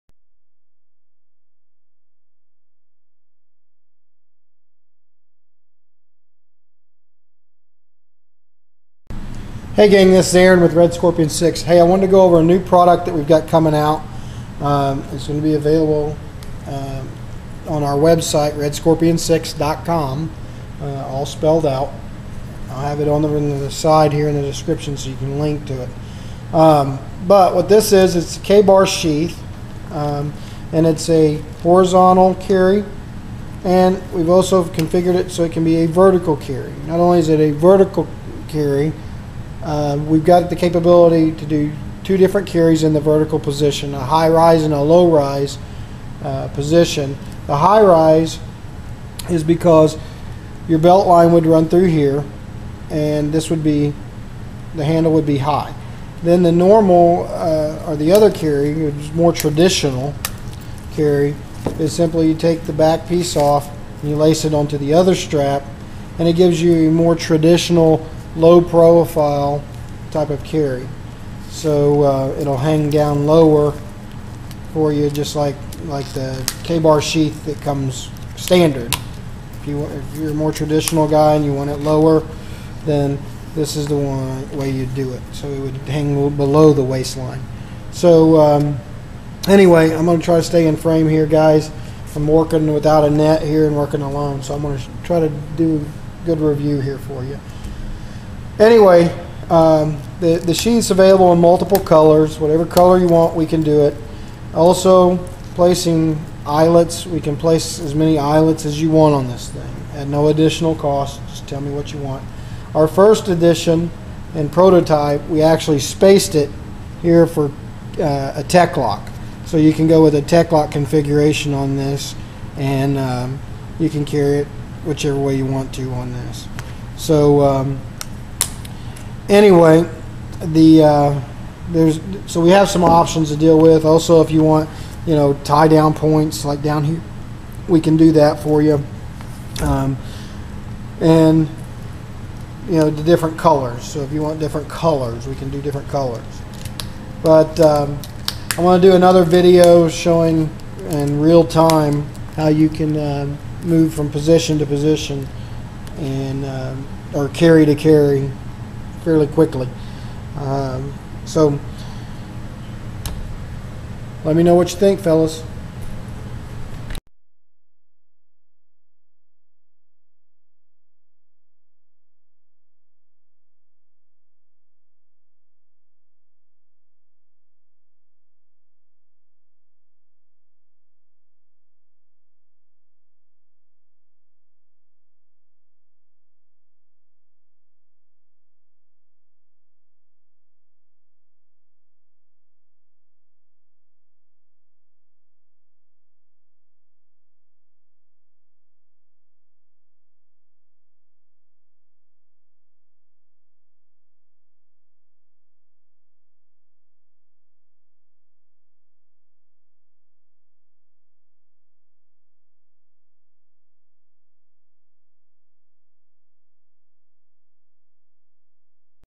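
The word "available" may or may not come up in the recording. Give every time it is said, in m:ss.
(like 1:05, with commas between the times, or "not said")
0:15, 1:40.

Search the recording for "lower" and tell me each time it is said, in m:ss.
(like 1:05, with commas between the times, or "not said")
1:13, 1:21.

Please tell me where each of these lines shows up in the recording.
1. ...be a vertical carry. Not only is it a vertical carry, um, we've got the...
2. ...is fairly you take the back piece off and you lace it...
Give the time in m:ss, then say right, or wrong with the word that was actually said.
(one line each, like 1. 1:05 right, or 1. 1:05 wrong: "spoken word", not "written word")
1. 0:35 right
2. 1:01 wrong: "simply", not "fairly".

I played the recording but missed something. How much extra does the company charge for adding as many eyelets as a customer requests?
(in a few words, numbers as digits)
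no additional cost.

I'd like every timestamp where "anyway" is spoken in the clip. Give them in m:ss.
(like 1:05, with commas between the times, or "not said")
1:29, 1:38, 2:09.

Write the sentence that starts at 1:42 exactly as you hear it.
Whatever color you want, we can do it.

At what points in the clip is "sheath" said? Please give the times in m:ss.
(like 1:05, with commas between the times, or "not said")
0:28, 1:17.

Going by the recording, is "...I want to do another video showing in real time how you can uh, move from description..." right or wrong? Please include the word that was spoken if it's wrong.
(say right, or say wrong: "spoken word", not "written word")
wrong: "position", not "description".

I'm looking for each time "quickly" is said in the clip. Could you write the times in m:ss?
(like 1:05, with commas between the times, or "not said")
2:39.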